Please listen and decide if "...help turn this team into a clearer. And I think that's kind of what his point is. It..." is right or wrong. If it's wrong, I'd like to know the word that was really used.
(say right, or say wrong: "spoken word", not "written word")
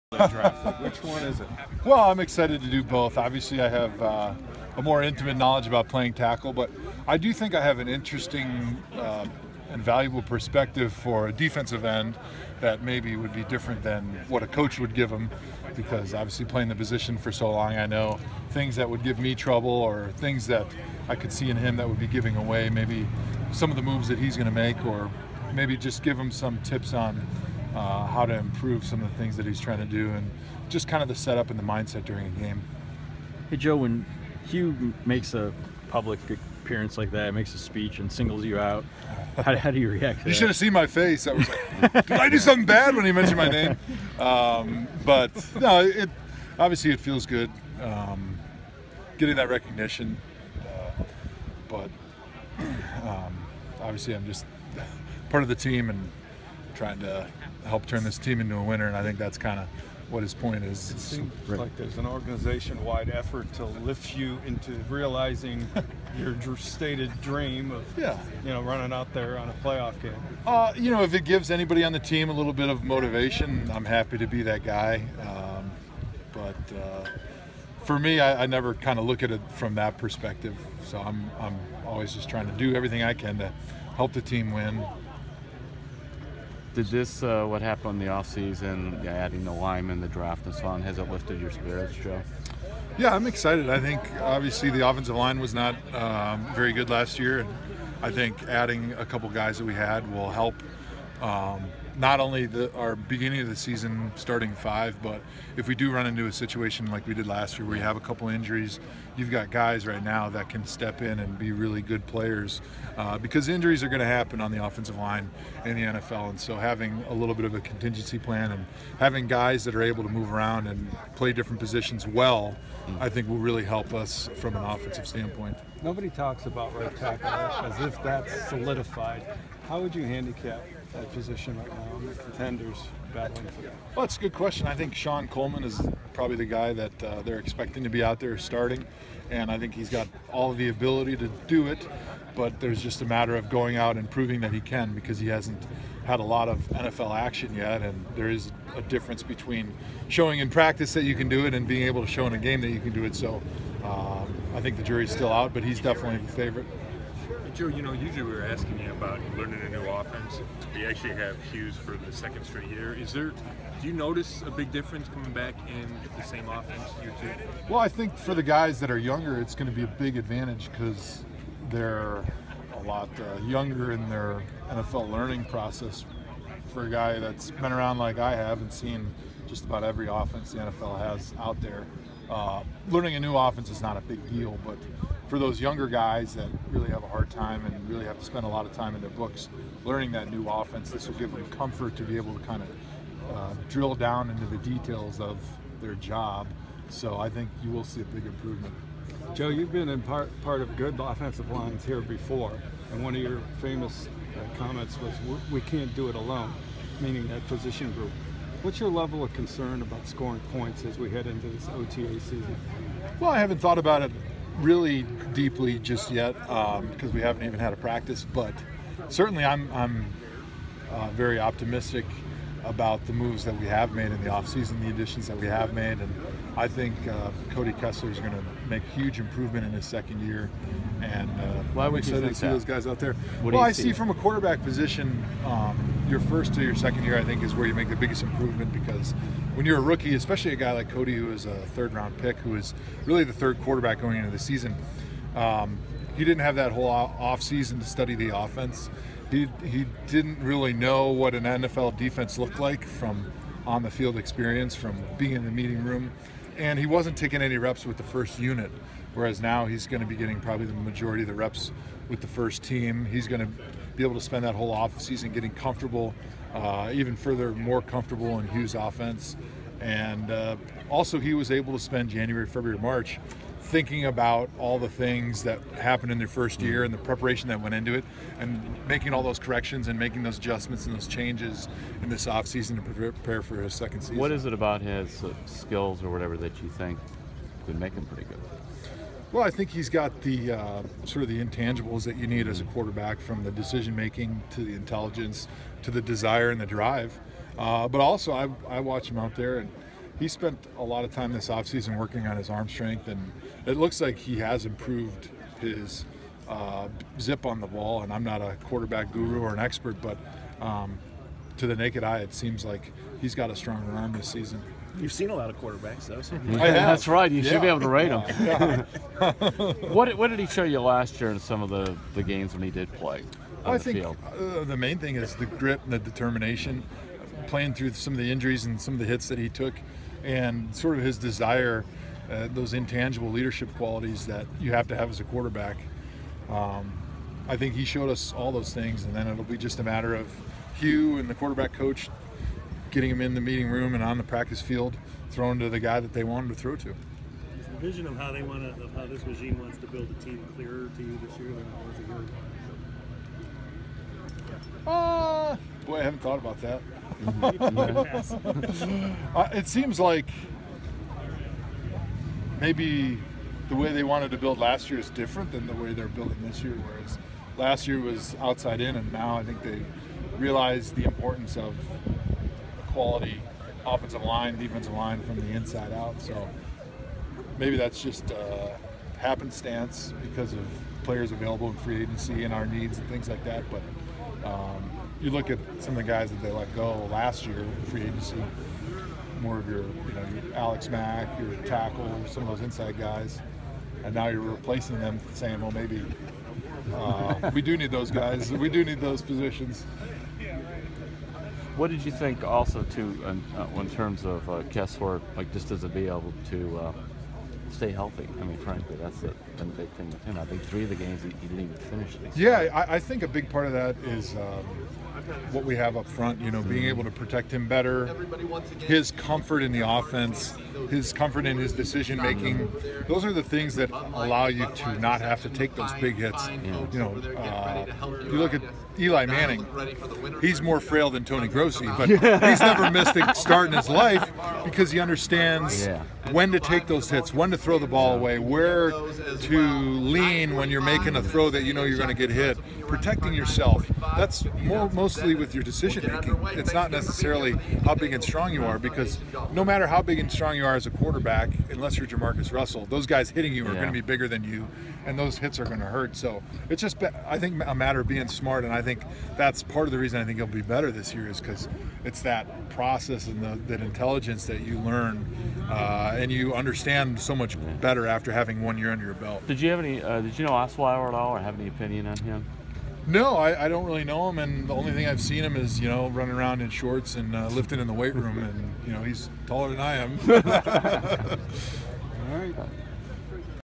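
wrong: "winner", not "clearer".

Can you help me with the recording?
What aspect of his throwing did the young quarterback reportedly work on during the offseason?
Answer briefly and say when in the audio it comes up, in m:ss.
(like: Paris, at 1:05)
Arm strength, at 5:02.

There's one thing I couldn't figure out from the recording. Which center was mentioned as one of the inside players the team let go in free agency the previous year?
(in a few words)
Alex Mack.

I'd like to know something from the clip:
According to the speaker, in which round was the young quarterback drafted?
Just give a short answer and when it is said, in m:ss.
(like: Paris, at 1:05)
Third round, at 4:01.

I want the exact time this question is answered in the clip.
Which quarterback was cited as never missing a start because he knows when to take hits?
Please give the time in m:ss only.
7:08.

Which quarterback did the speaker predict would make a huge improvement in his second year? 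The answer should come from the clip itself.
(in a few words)
Cody Kessler.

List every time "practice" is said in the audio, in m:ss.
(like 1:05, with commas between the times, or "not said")
2:30, 3:37, 5:44.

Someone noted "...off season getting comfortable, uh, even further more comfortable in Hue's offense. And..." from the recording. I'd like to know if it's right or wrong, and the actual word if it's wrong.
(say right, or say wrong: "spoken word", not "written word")
right.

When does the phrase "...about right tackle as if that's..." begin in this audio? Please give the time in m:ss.
2:06.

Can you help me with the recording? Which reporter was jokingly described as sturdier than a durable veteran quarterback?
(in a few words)
Tony Grossi.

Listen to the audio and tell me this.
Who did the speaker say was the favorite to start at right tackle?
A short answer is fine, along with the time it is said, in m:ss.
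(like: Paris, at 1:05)
Shon Coleman, at 2:14.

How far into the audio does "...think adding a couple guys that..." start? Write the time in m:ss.
1:38.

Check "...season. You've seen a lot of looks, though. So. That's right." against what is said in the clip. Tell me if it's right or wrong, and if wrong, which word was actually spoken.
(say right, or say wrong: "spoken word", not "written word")
wrong: "quarterbacks", not "looks".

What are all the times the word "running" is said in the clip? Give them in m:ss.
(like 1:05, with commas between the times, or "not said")
1:08, 7:56.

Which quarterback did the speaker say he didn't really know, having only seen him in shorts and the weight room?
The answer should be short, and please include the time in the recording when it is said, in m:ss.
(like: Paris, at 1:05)
Osweiler, at 7:50.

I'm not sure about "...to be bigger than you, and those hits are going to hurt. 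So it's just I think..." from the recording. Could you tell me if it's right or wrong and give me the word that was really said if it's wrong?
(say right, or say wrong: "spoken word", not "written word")
right.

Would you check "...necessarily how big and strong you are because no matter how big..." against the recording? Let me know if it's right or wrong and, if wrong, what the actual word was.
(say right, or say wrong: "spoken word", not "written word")
right.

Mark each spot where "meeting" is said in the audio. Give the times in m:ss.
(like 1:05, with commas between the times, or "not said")
4:15, 5:43.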